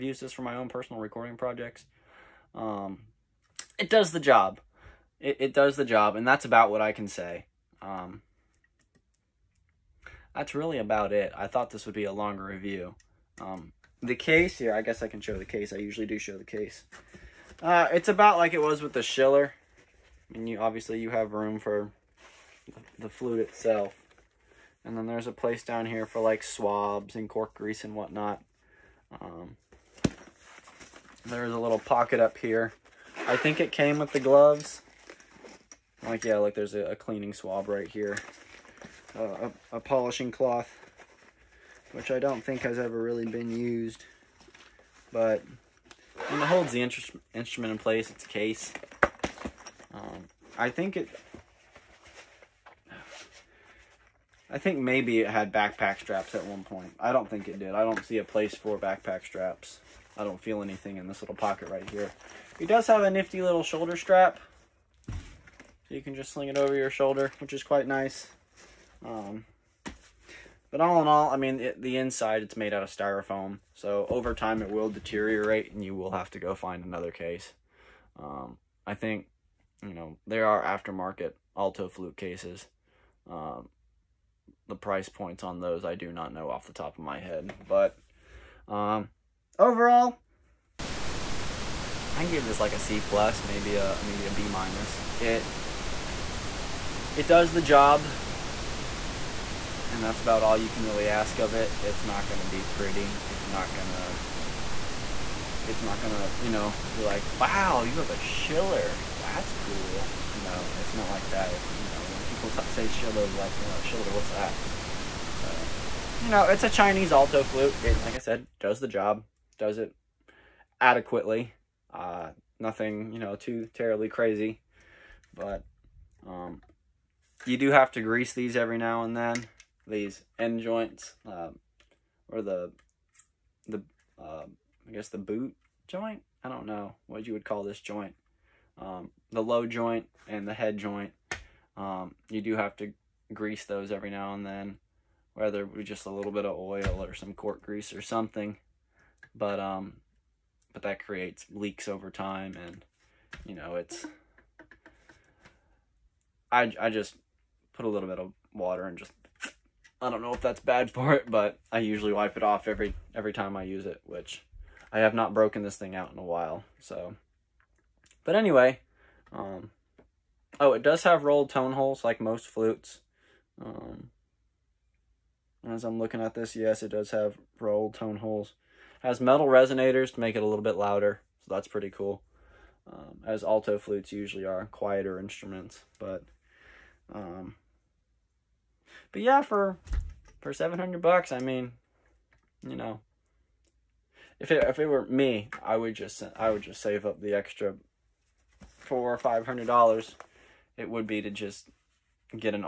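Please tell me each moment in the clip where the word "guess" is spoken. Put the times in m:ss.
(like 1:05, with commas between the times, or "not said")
0:14, 2:14.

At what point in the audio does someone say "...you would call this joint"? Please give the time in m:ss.
2:17.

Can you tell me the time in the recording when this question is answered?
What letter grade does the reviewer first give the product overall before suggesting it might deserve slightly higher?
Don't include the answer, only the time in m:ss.
1:32.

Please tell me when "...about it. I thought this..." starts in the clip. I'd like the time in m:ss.
0:10.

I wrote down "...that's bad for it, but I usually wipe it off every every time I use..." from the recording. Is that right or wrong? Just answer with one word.
right.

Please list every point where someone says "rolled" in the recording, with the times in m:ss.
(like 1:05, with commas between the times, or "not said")
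2:51, 2:57.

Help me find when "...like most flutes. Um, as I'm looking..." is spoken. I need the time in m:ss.
2:52.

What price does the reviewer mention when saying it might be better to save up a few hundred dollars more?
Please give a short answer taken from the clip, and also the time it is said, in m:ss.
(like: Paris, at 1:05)
$700, at 3:10.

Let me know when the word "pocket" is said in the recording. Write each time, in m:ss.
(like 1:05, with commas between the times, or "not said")
0:31, 1:01.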